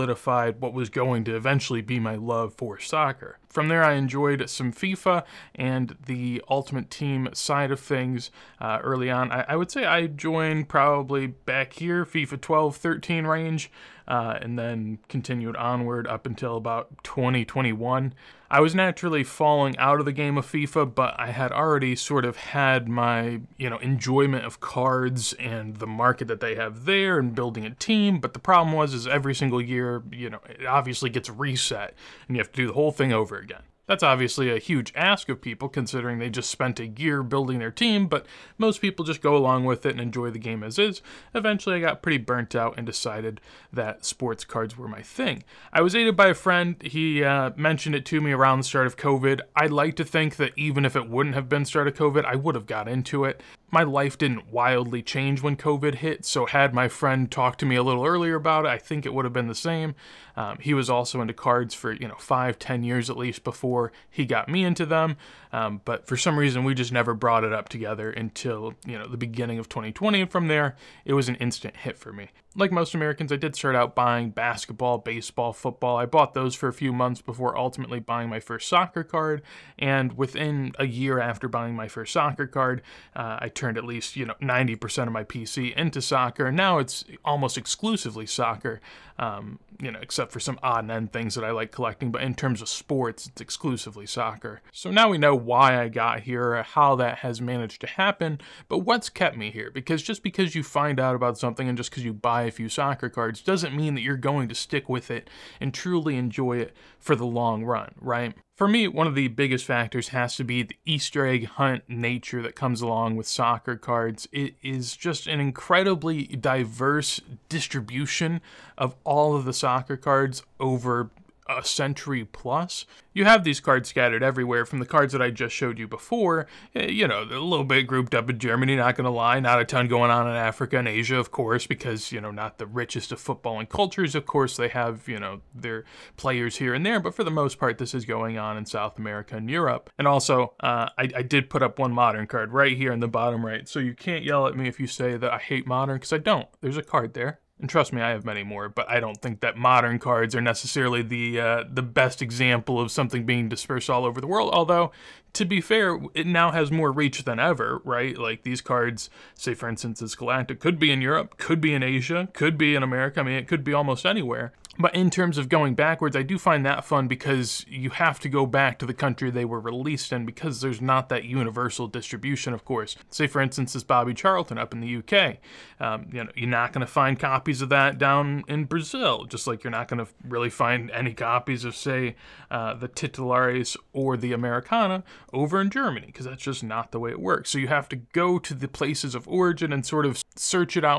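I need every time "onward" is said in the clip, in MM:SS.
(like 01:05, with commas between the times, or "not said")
00:15.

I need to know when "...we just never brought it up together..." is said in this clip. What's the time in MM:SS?
01:06.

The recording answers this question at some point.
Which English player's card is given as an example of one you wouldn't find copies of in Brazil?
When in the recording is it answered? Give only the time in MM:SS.
02:53.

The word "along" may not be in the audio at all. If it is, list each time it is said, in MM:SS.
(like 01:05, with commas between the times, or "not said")
00:39, 01:52.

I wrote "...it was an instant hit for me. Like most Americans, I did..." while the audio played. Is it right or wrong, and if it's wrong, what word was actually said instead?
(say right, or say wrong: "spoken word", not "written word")
right.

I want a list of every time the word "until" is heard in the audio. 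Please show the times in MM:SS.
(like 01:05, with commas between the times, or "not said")
00:16, 01:08.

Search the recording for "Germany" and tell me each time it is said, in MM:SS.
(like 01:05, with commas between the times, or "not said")
02:08, 03:05.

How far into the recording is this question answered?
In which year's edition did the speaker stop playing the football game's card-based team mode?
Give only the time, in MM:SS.
00:17.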